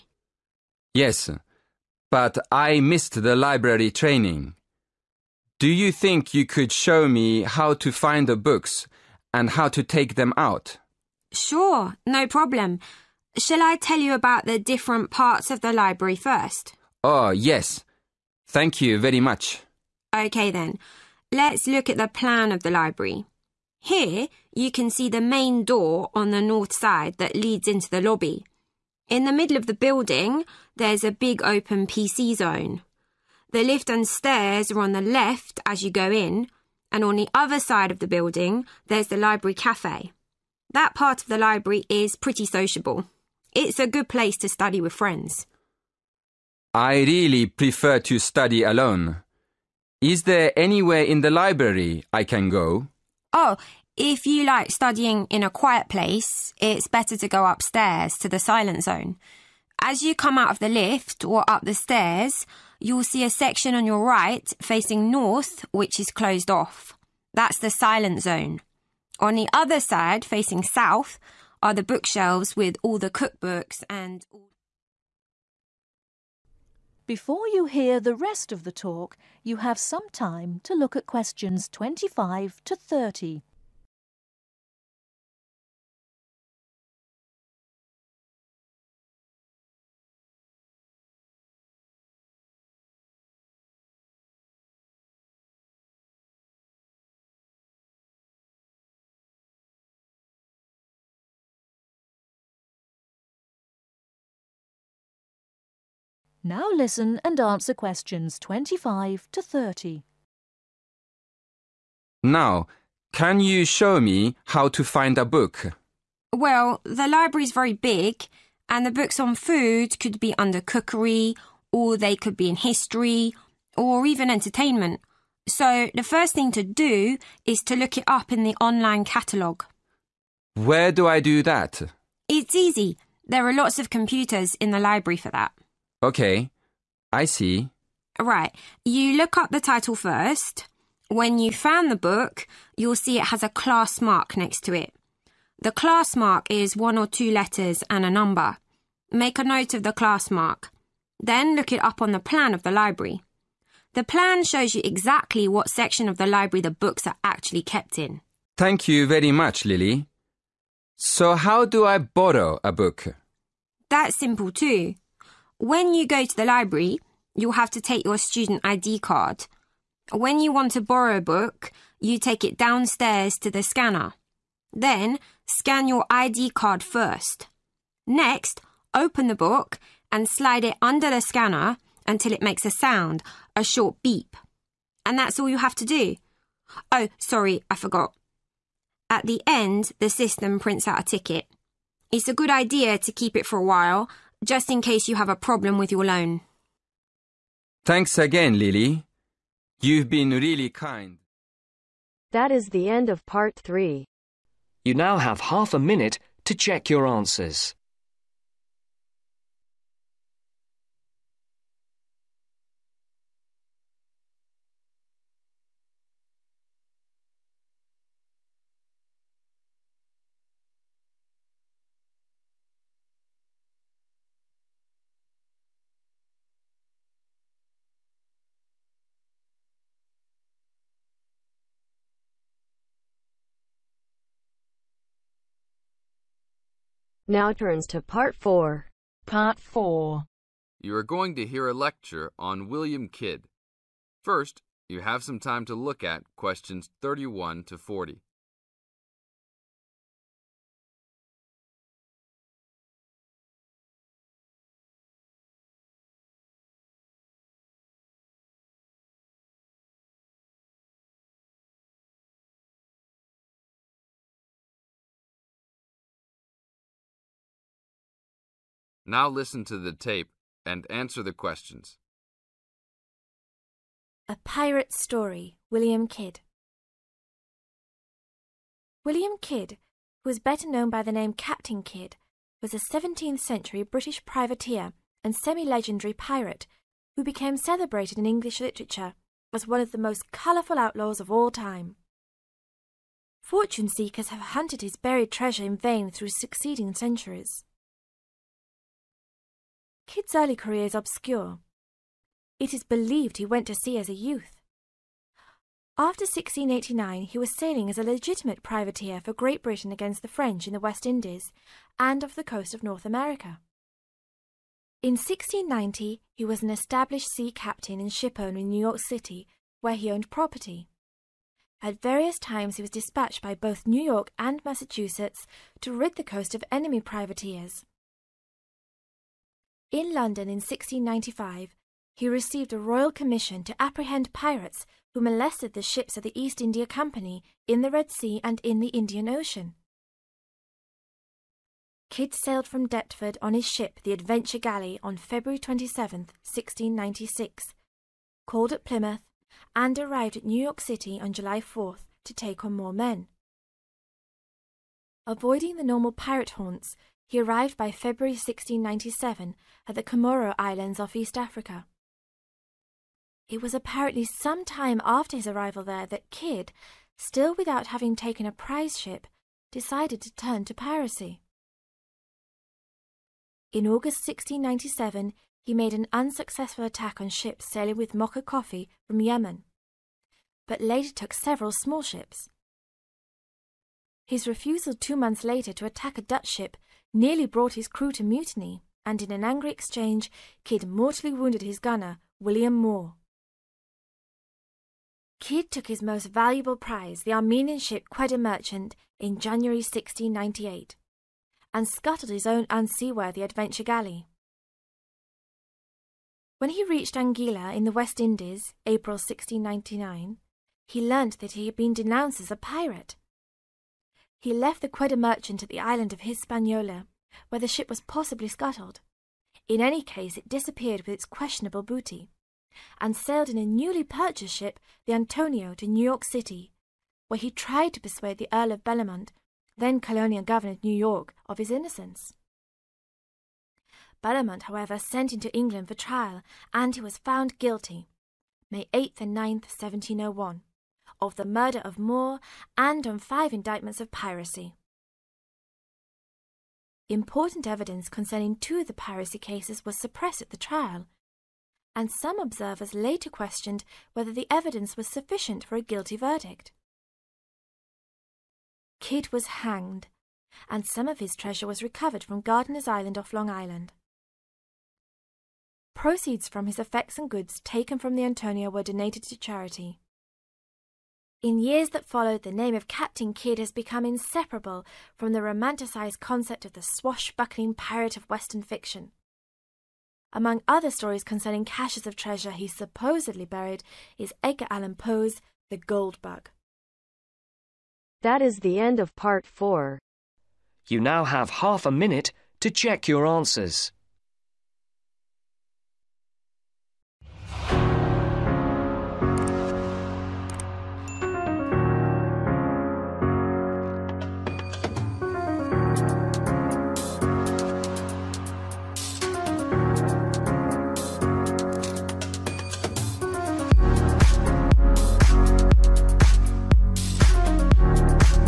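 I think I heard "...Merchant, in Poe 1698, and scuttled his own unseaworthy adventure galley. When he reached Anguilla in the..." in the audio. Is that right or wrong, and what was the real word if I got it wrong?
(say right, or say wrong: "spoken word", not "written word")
wrong: "January", not "Poe".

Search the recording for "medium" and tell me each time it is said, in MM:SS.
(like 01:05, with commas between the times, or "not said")
not said.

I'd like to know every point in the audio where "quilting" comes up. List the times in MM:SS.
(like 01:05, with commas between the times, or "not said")
not said.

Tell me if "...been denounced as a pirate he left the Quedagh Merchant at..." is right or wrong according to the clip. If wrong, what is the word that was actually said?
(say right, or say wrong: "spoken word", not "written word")
right.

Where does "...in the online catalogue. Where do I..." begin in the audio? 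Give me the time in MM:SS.
02:08.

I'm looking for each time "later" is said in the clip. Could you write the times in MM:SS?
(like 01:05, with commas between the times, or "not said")
06:20, 06:25, 07:32.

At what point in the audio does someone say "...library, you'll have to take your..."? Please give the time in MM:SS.
02:46.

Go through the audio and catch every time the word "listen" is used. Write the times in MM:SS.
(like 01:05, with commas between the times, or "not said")
01:46, 04:29.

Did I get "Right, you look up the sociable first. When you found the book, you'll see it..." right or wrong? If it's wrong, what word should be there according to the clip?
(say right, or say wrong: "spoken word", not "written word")
wrong: "title", not "sociable".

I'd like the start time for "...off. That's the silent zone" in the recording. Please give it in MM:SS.
01:06.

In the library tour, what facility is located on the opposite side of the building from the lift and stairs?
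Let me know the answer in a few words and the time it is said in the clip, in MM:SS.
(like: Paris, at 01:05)
library cafe, at 00:39.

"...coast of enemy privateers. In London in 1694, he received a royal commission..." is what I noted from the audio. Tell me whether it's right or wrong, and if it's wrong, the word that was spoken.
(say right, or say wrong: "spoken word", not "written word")
wrong: "1695", not "1694".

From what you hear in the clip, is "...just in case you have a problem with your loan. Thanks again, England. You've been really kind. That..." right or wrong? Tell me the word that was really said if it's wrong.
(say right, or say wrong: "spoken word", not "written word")
wrong: "Lily", not "England".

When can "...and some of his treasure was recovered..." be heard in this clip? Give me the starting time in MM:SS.
07:40.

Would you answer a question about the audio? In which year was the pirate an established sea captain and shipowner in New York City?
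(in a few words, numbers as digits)
1690.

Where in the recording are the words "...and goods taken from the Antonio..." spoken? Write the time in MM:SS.
07:47.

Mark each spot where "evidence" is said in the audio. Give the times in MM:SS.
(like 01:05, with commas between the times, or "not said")
07:27, 07:34.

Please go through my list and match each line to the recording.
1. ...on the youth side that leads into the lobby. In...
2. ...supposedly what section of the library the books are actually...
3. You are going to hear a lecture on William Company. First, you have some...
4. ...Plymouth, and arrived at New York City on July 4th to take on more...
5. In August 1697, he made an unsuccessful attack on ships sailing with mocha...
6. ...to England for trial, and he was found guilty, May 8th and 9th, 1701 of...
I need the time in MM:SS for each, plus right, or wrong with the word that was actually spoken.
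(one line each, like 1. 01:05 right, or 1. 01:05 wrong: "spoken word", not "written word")
1. 00:26 wrong: "north", not "youth"
2. 02:34 wrong: "exactly", not "supposedly"
3. 04:00 wrong: "Kidd", not "Company"
4. 05:48 right
5. 06:13 right
6. 07:15 right.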